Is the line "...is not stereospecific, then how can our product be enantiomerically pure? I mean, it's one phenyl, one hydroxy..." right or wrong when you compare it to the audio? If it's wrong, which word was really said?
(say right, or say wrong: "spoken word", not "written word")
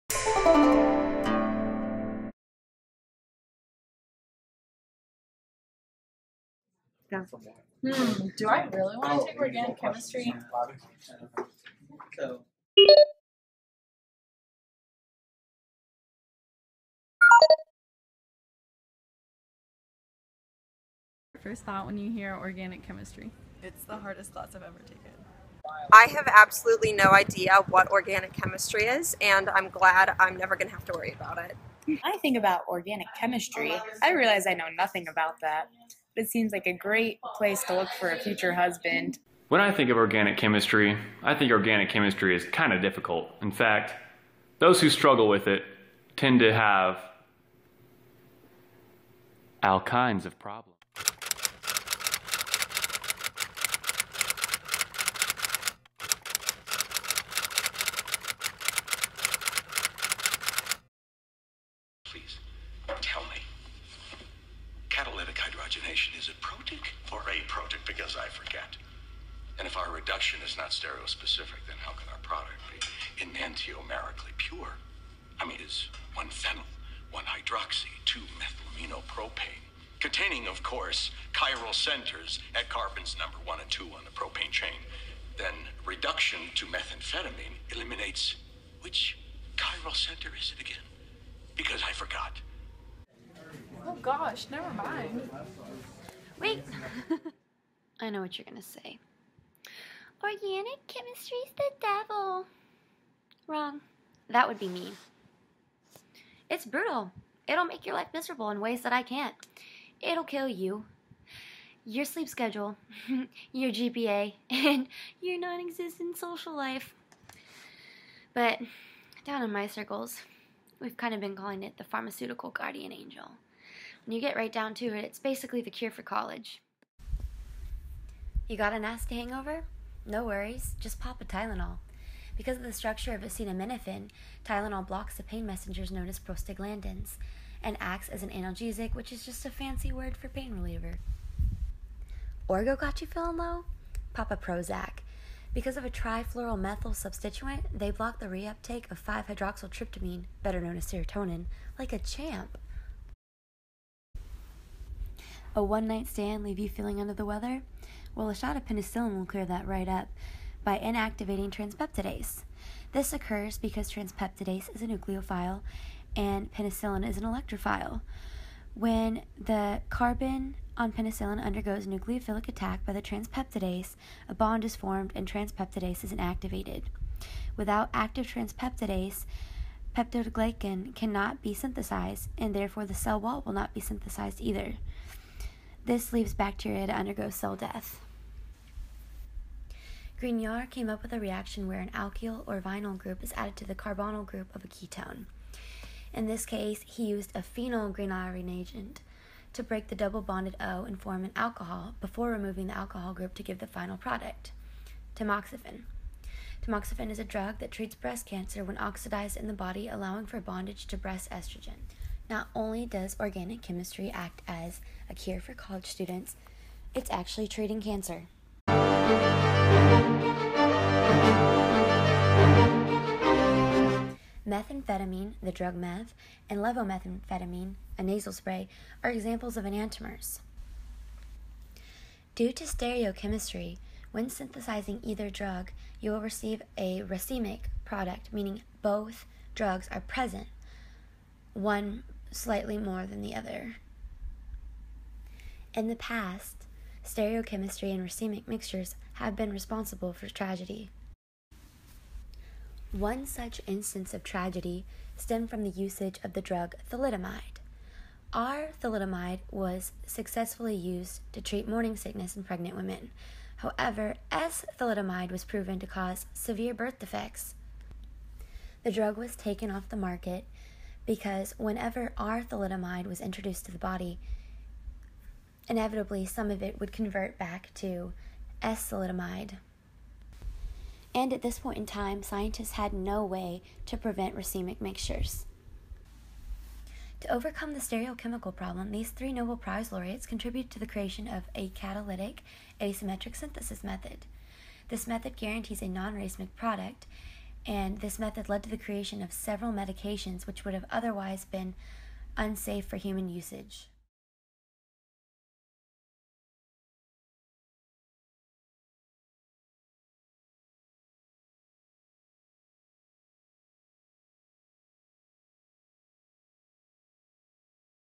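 right.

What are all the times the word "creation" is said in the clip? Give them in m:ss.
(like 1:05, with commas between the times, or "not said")
4:50, 4:58.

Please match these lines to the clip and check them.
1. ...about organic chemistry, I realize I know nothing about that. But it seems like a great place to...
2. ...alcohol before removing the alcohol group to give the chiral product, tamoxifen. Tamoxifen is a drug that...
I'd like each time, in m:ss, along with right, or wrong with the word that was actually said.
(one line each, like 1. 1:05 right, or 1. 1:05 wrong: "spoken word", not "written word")
1. 0:32 right
2. 3:21 wrong: "final", not "chiral".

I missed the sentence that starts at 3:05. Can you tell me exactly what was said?
This leaves bacteria to undergo cell death.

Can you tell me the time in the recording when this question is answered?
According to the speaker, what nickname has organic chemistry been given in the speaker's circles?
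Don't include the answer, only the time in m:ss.
2:01.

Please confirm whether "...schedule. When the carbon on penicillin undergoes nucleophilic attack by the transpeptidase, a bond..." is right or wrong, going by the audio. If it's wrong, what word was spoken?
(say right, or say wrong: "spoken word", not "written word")
wrong: "electrophile", not "schedule".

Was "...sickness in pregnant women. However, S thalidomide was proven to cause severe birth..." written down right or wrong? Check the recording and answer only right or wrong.
right.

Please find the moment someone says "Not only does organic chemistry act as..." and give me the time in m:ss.
3:32.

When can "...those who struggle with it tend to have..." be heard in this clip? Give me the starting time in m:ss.
0:44.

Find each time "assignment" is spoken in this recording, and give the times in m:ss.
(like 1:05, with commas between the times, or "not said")
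not said.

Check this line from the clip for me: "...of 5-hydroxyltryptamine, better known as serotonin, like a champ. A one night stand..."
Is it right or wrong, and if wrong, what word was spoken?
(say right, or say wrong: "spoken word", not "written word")
right.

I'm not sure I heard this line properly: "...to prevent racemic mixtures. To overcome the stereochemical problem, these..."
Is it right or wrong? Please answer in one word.
right.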